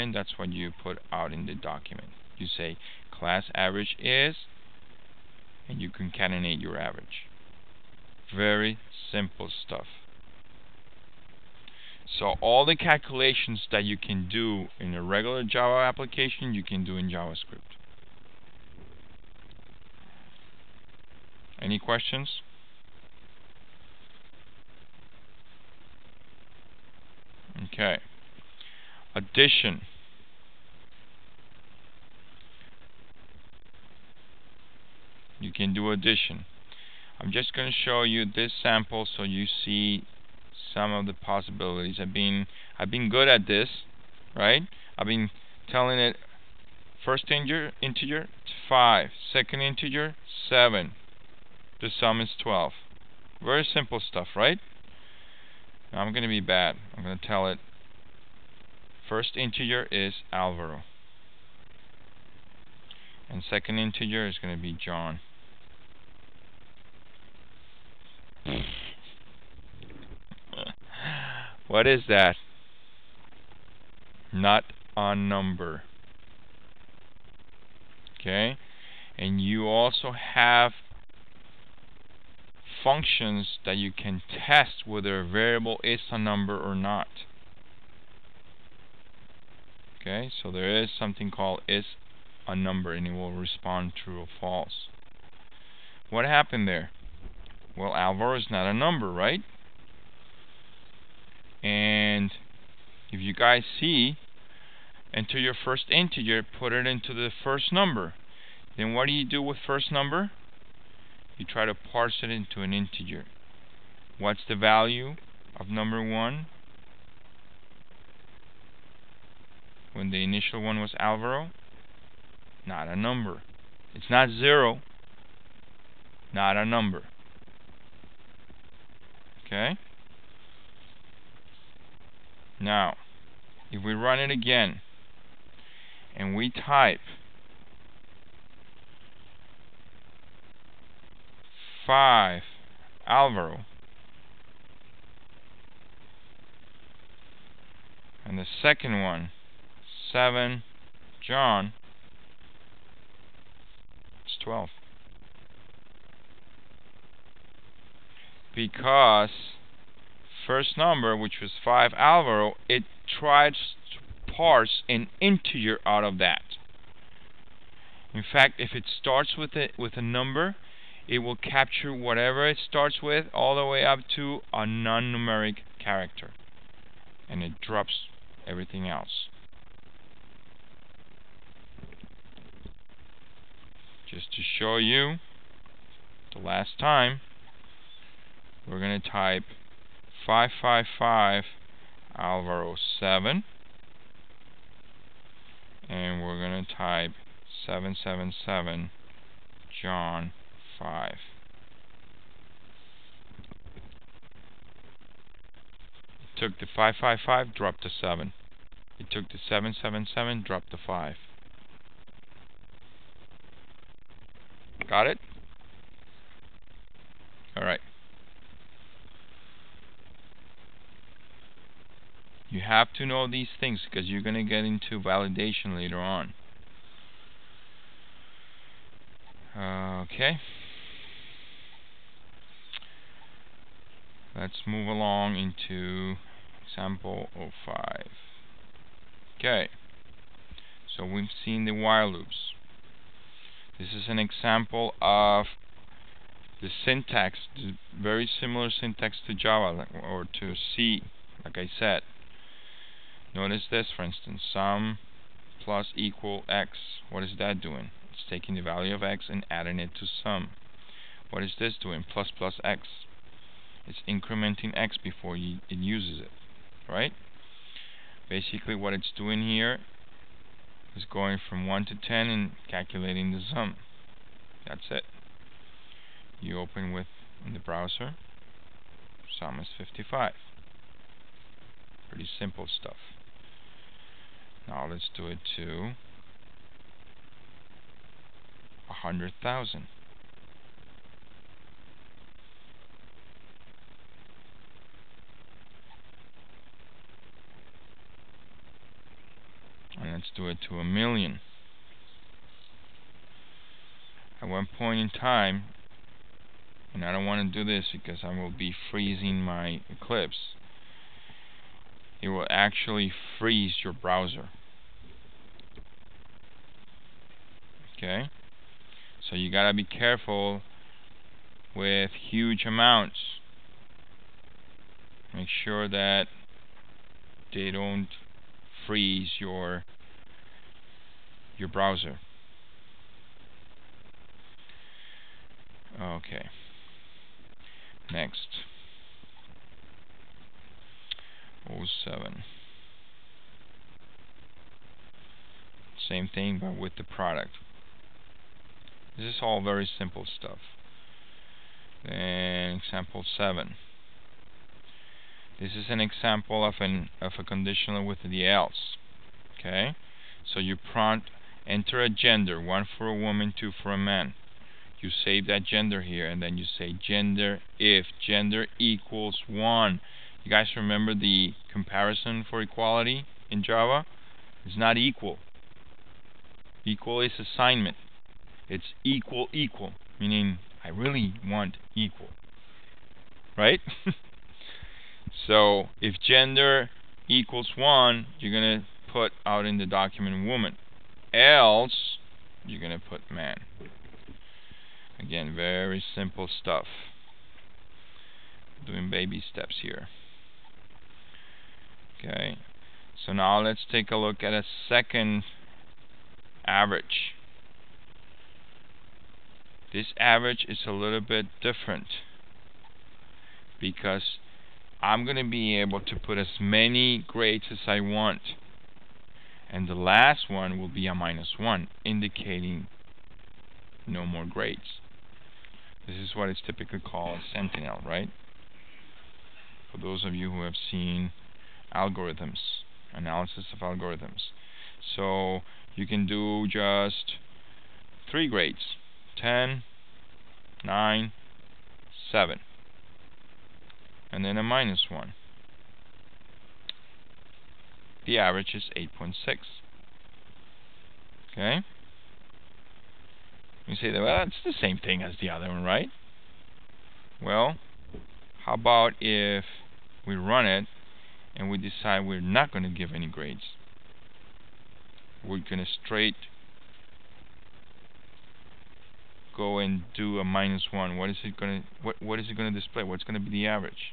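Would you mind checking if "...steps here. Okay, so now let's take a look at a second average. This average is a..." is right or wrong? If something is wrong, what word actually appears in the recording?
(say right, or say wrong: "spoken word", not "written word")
right.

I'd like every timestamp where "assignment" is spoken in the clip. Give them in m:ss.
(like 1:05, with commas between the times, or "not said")
6:17.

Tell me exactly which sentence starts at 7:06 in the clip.
This is what is typically called Sentinel, right?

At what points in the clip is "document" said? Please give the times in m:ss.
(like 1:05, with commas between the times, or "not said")
0:01, 6:29.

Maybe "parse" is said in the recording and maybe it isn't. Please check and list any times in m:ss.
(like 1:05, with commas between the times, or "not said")
1:51, 2:44.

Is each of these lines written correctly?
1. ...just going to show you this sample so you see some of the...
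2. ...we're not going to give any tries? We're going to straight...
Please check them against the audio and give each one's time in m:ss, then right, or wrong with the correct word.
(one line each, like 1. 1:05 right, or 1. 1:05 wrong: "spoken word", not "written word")
1. 0:37 right
2. 7:42 wrong: "grades", not "tries".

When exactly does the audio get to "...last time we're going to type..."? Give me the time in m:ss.
3:06.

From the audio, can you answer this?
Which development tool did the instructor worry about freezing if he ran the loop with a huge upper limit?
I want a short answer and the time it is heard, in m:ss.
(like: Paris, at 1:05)
Eclipse, at 5:08.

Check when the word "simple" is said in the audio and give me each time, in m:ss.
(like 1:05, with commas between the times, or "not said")
0:09, 0:53, 4:42, 5:49, 6:36.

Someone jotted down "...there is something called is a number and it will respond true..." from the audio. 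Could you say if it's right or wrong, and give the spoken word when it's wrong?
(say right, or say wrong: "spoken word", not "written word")
right.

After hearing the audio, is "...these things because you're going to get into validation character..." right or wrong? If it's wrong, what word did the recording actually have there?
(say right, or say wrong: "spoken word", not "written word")
wrong: "later", not "character".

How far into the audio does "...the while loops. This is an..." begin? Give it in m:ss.
4:01.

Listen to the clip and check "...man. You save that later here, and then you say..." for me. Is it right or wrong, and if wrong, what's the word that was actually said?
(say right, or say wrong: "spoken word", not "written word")
wrong: "gender", not "later".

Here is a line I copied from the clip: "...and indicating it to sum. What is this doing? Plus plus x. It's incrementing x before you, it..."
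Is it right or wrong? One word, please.
wrong.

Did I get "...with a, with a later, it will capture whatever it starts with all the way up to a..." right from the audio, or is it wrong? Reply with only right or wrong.
wrong.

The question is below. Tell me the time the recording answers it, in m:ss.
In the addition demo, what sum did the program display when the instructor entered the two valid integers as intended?
0:51.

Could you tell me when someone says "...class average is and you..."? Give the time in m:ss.
0:03.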